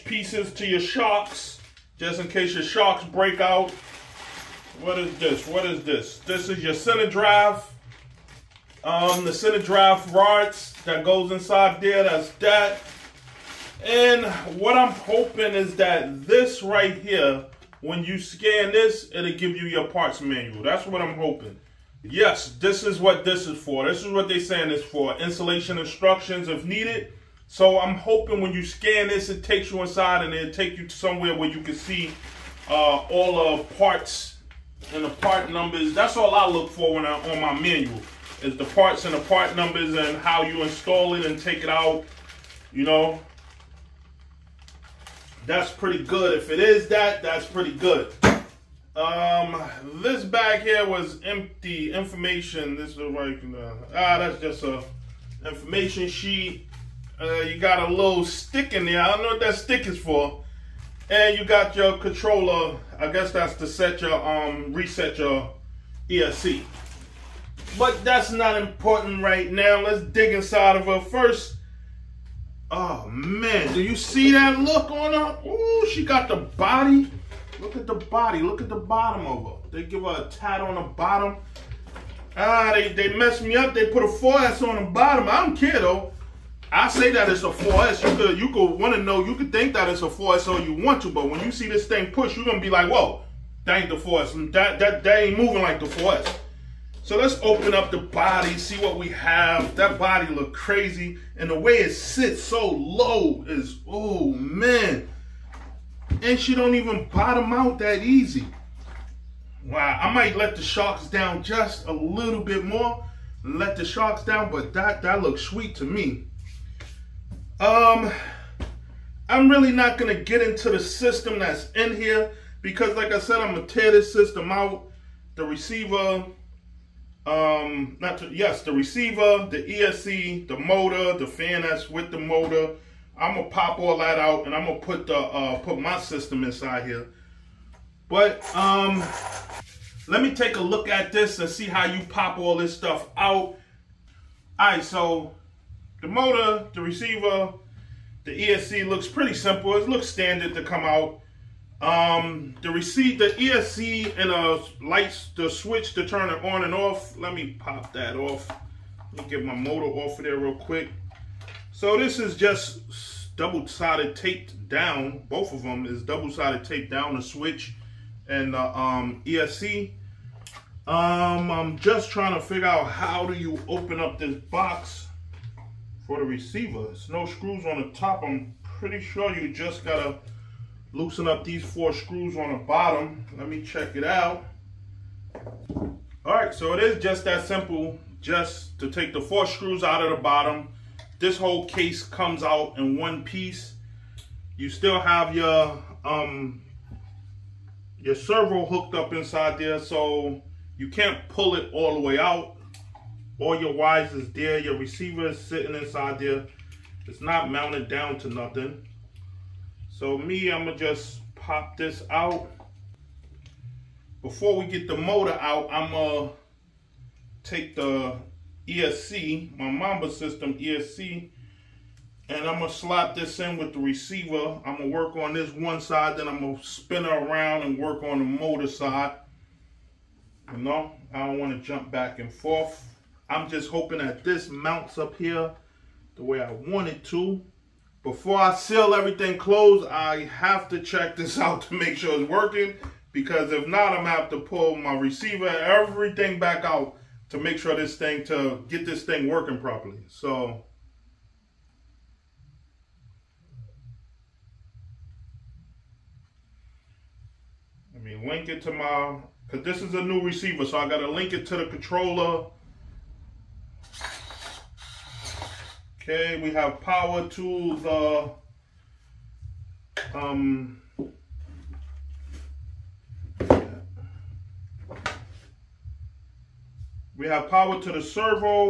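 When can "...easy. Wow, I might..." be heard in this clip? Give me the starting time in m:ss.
1:48.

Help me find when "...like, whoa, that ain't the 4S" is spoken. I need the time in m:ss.
1:32.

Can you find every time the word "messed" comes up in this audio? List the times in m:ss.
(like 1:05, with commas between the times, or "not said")
1:23.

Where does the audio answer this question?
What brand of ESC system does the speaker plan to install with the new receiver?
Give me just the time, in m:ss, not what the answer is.
3:39.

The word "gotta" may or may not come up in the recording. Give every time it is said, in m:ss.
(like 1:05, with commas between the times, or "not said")
2:59, 4:20.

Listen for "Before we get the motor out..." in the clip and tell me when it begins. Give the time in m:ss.
3:34.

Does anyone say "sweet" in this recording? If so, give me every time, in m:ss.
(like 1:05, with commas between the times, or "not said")
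1:55.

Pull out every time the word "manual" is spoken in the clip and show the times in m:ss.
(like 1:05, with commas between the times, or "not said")
0:20, 0:37.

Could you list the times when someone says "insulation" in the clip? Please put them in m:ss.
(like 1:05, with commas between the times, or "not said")
0:25.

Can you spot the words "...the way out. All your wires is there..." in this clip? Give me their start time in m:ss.
3:21.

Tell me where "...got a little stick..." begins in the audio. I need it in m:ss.
0:57.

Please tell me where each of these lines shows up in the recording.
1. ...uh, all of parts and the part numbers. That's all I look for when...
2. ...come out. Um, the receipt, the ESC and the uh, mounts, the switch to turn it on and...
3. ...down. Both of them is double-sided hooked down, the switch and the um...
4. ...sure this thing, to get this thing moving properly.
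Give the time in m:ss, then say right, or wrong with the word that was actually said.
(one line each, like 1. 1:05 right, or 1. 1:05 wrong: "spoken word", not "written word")
1. 0:32 right
2. 2:30 wrong: "lights", not "mounts"
3. 2:44 wrong: "taped", not "hooked"
4. 4:07 wrong: "working", not "moving".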